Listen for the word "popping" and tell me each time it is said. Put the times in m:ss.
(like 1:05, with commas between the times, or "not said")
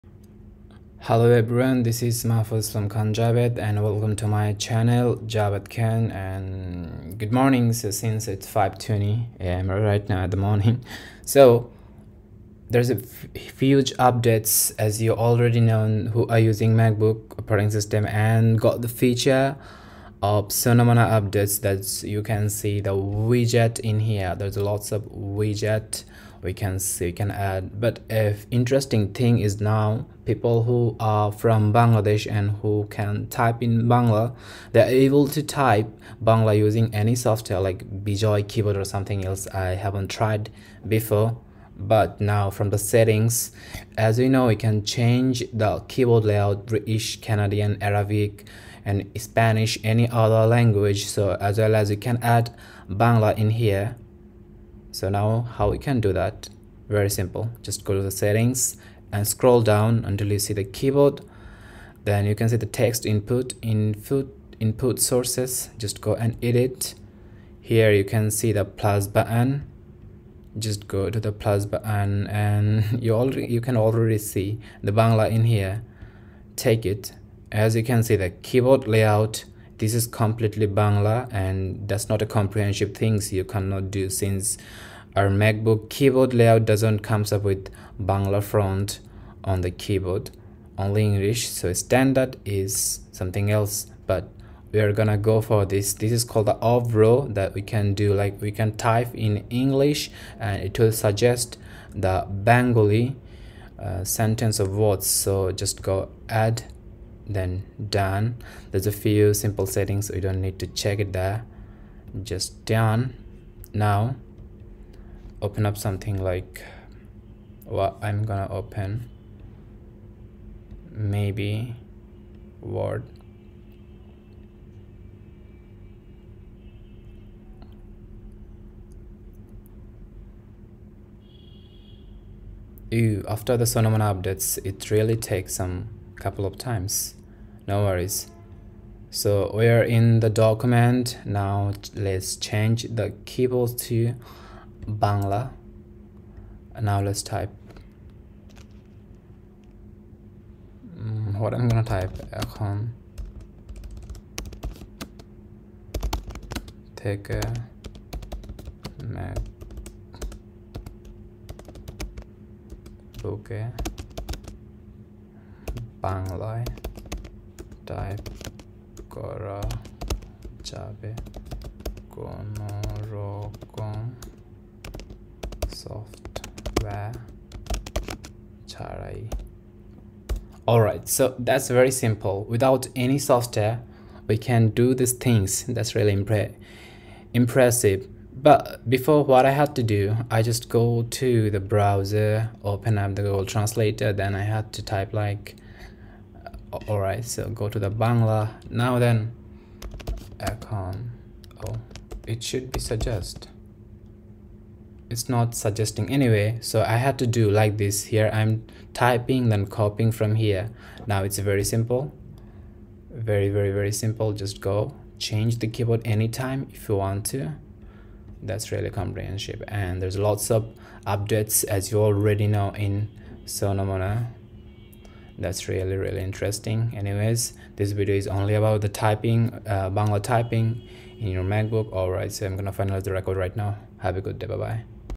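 not said.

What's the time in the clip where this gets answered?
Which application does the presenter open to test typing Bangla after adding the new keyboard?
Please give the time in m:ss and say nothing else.
2:02.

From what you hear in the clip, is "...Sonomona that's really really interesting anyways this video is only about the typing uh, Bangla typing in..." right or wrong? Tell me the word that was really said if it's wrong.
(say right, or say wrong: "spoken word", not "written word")
right.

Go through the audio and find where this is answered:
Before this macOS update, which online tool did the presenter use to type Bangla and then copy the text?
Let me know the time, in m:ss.
3:13.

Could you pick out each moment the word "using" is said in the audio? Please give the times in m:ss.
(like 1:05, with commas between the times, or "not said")
0:16, 0:36.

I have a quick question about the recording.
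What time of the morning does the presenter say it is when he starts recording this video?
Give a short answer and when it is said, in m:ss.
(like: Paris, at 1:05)
5:20 am, at 0:08.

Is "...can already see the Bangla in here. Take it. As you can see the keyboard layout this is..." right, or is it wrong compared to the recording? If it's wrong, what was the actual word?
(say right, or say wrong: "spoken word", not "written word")
right.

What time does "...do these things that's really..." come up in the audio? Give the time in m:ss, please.
3:04.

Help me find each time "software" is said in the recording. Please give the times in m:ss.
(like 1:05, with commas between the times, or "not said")
0:37, 2:55, 3:03.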